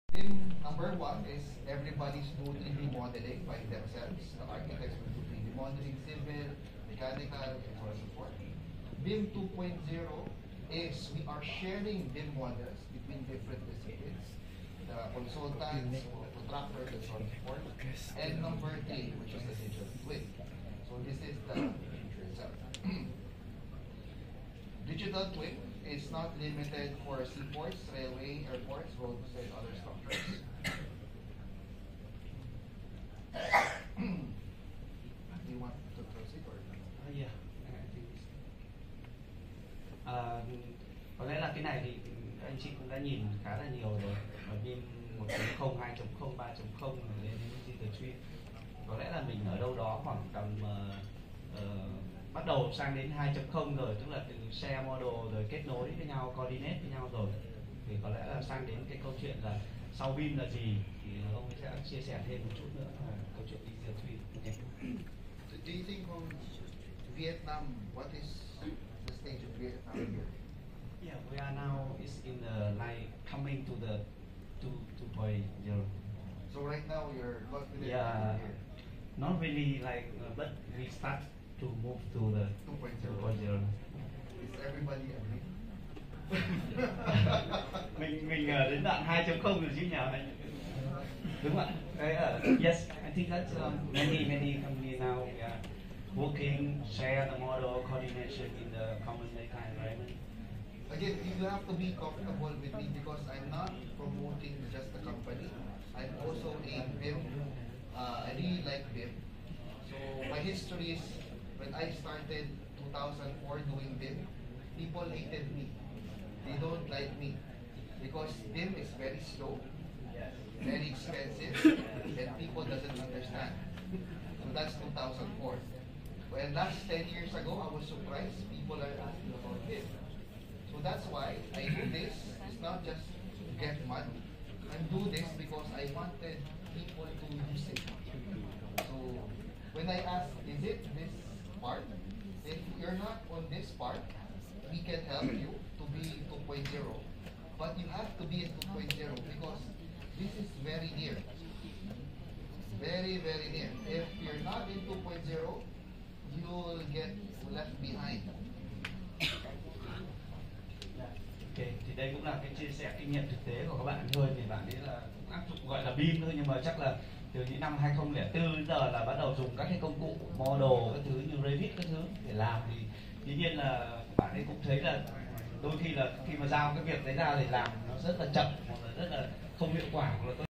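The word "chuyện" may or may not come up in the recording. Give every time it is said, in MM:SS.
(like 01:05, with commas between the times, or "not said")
00:59, 01:03.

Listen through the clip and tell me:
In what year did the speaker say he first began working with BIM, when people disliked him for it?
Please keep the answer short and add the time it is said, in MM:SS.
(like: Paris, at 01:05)
2004, at 01:51.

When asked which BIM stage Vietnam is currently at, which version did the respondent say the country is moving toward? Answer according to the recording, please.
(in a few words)
2.0.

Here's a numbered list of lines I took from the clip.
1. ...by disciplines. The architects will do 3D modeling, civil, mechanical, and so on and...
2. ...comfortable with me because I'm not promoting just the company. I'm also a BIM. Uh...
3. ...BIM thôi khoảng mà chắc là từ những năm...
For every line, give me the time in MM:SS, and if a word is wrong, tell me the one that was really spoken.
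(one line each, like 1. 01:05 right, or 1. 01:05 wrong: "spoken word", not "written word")
1. 00:03 wrong: "themselves", not "disciplines"
2. 01:41 right
3. 02:45 wrong: "nhưng", not "khoảng".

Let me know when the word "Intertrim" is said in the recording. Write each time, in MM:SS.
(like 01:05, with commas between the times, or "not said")
00:47, 01:03.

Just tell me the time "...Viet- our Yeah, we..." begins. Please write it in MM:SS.
01:09.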